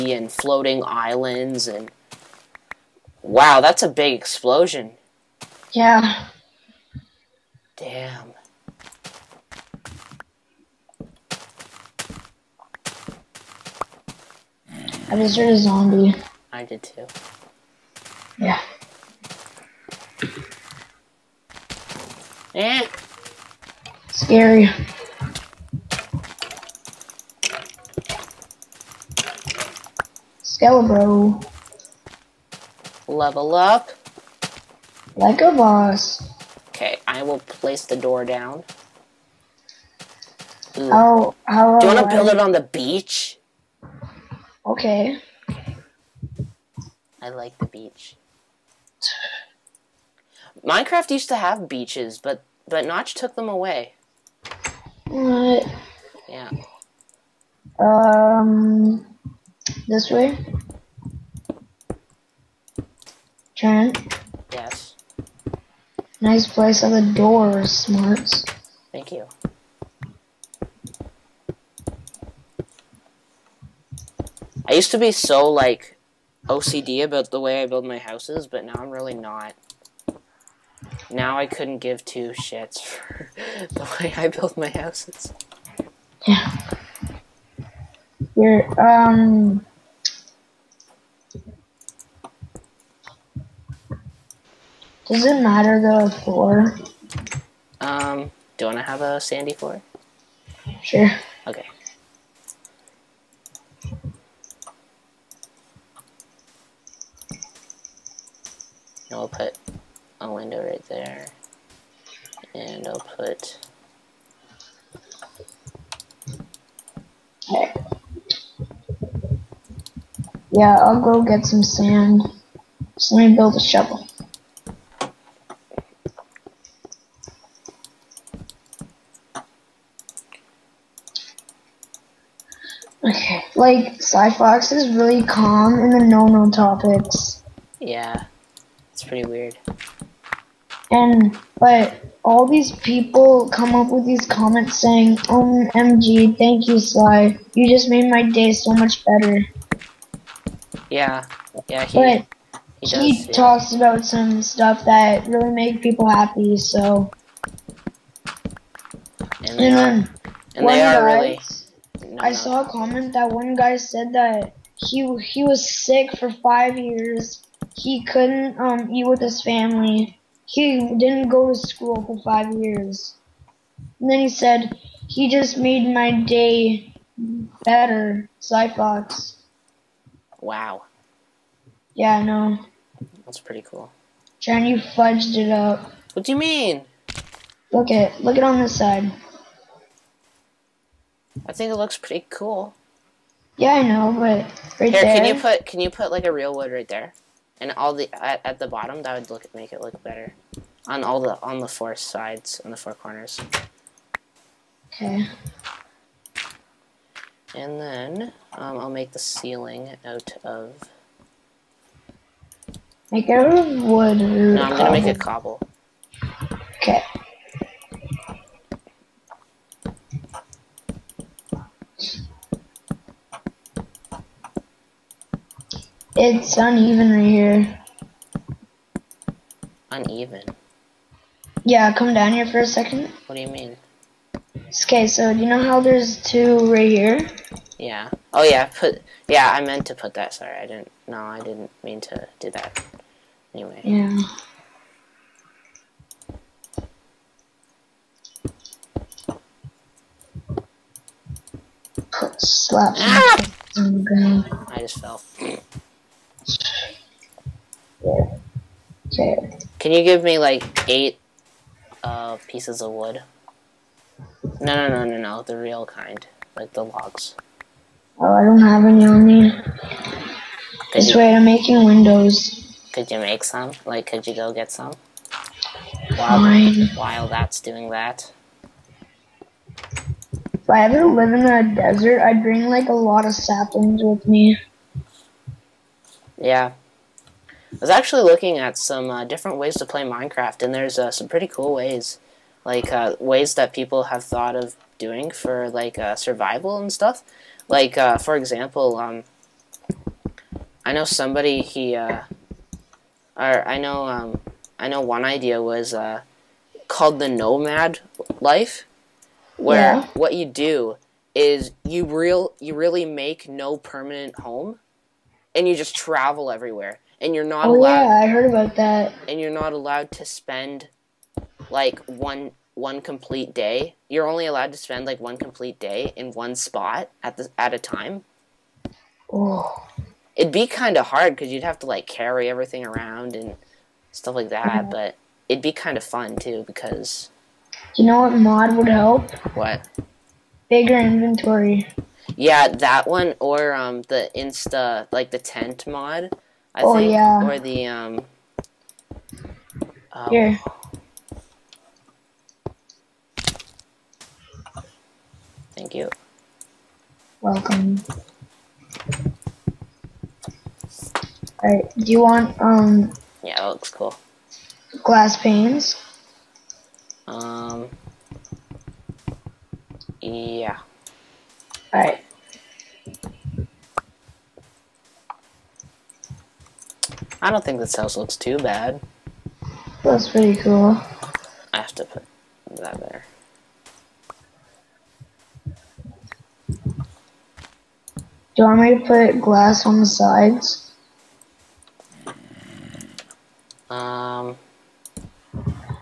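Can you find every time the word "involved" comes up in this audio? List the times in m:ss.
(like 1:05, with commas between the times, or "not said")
not said.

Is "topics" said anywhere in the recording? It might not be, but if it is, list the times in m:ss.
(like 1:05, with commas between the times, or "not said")
2:16.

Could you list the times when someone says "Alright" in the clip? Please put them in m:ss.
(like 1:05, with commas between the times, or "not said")
6:01, 6:11.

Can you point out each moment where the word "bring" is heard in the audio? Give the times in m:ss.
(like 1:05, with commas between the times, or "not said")
4:42.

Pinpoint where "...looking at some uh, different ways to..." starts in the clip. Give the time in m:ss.
4:48.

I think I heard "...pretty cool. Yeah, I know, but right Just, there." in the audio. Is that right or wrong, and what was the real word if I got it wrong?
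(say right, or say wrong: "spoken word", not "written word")
wrong: "Here", not "Just".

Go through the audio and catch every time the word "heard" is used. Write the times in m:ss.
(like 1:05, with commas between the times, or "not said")
0:15, 5:18.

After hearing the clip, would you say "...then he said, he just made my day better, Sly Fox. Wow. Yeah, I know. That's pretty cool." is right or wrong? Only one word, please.
right.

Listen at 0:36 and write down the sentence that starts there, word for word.
Okay, I will place the door down.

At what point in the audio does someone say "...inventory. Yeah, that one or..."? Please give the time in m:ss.
5:40.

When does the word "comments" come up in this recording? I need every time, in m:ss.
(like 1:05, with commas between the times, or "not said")
2:24, 2:42.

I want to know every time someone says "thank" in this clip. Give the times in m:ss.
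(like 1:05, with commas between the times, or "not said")
1:08, 2:26, 5:55.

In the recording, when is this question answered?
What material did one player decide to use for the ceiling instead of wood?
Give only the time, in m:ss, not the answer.
3:35.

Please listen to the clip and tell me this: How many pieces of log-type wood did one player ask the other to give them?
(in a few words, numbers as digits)
8.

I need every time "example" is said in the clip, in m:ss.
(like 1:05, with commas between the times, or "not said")
4:58.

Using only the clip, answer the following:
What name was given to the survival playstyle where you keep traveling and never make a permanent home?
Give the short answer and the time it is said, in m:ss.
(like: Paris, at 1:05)
The nomad life, at 5:07.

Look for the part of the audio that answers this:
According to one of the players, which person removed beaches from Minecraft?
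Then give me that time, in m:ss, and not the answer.
0:52.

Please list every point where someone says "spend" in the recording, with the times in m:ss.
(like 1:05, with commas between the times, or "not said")
5:20, 5:24.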